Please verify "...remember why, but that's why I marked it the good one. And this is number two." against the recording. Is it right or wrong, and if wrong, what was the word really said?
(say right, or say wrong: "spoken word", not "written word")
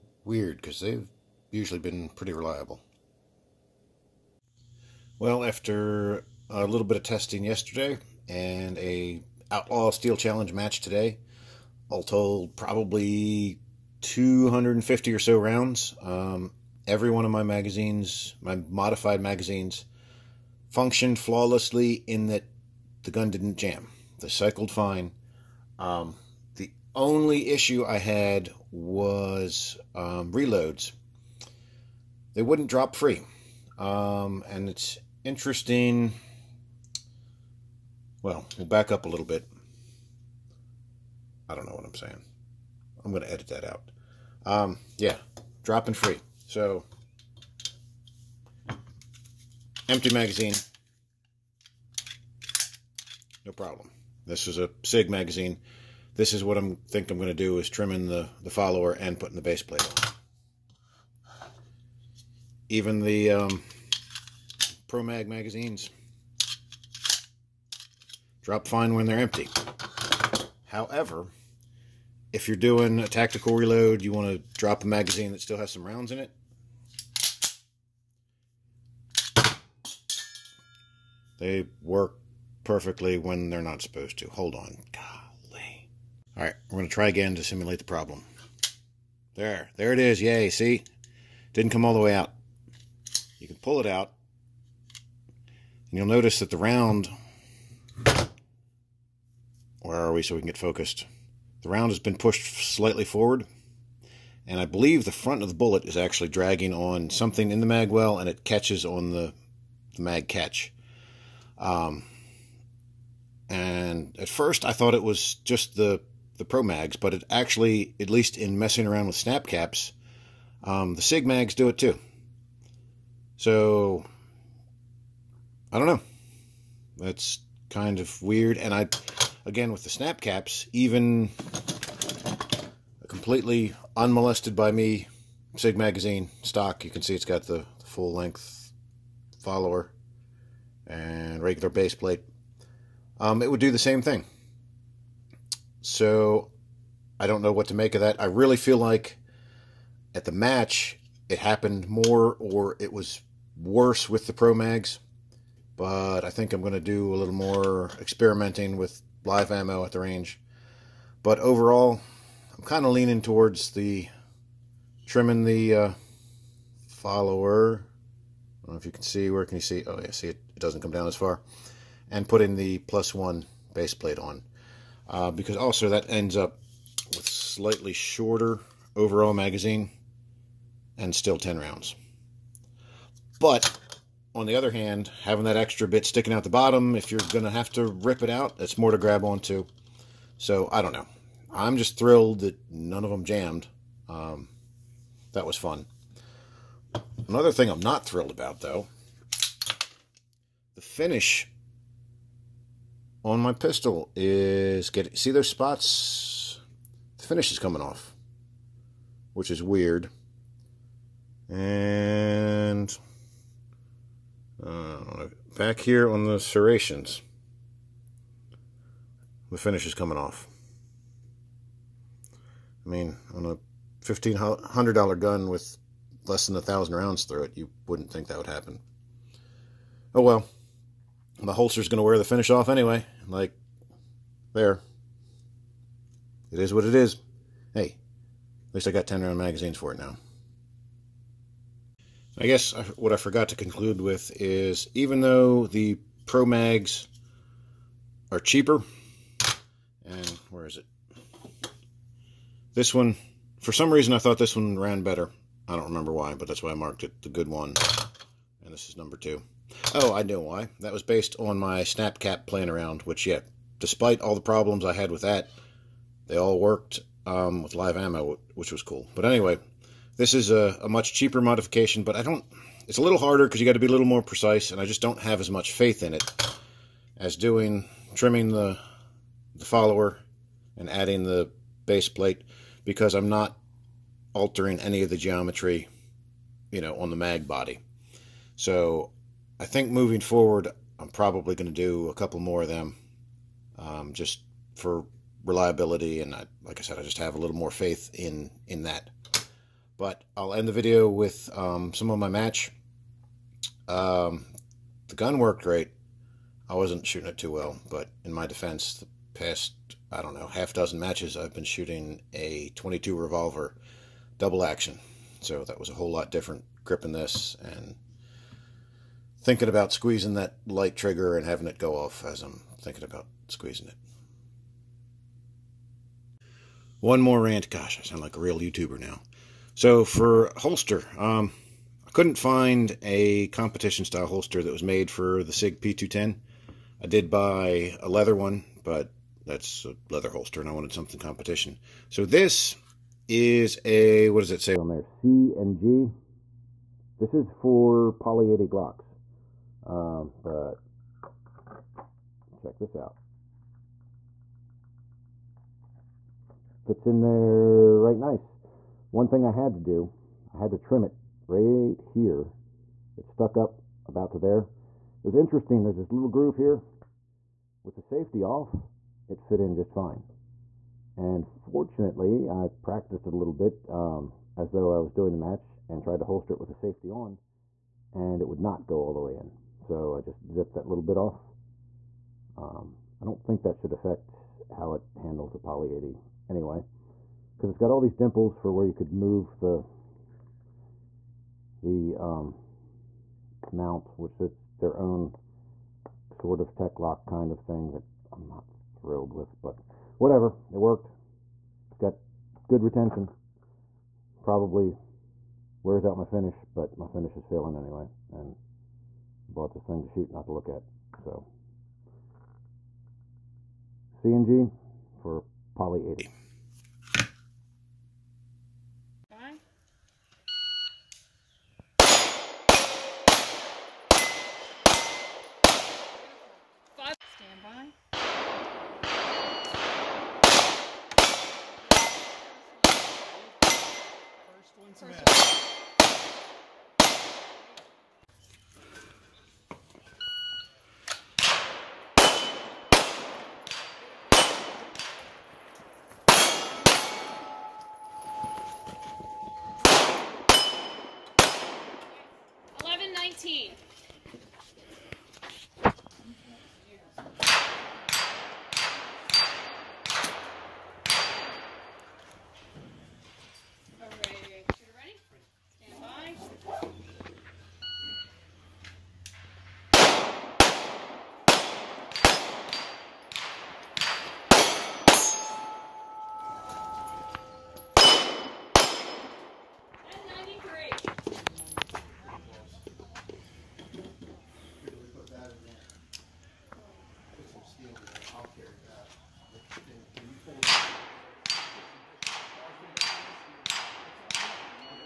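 right.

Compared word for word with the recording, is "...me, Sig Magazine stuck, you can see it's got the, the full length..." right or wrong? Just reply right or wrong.
wrong.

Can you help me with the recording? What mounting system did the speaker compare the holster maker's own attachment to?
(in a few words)
Tek-Lok.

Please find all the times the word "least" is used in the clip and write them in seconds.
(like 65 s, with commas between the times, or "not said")
118 s, 238 s.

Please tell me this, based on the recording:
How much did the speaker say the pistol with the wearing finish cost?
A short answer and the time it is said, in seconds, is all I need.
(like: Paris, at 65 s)
$1,500, at 224 s.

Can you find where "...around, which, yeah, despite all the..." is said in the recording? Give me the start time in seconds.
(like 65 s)
262 s.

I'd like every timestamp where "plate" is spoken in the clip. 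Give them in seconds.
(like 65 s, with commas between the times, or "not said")
59 s, 141 s, 173 s, 282 s.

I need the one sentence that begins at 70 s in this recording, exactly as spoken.
However, if you're doing a tactical reload, you want to drop a magazine that still has some rounds in it.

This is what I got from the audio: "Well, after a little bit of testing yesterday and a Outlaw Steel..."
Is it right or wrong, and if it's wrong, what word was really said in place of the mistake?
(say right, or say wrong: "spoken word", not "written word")
right.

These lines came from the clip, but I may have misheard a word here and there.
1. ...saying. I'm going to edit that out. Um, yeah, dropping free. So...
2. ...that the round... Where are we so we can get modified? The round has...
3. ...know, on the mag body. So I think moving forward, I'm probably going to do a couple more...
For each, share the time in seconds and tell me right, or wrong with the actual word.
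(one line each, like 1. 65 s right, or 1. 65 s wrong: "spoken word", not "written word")
1. 41 s right
2. 96 s wrong: "focused", not "modified"
3. 286 s right.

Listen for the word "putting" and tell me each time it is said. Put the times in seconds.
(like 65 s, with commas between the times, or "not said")
59 s, 172 s.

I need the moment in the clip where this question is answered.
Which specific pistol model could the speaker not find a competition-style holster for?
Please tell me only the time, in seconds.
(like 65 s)
335 s.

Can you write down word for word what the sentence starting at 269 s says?
But anyway, this is a, a much cheaper modification, but I don't...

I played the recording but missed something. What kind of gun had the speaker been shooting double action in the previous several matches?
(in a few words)
22 revolver.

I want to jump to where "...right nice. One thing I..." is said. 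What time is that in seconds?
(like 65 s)
357 s.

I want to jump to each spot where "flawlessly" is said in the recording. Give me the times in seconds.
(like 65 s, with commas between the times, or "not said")
21 s.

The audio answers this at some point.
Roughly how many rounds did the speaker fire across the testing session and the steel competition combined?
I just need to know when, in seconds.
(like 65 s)
14 s.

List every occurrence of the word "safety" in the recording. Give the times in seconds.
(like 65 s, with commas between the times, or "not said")
368 s, 376 s.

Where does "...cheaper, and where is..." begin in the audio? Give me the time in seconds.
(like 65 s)
248 s.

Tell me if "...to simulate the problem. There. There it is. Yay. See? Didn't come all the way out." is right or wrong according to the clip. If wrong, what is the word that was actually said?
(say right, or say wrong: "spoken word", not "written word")
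right.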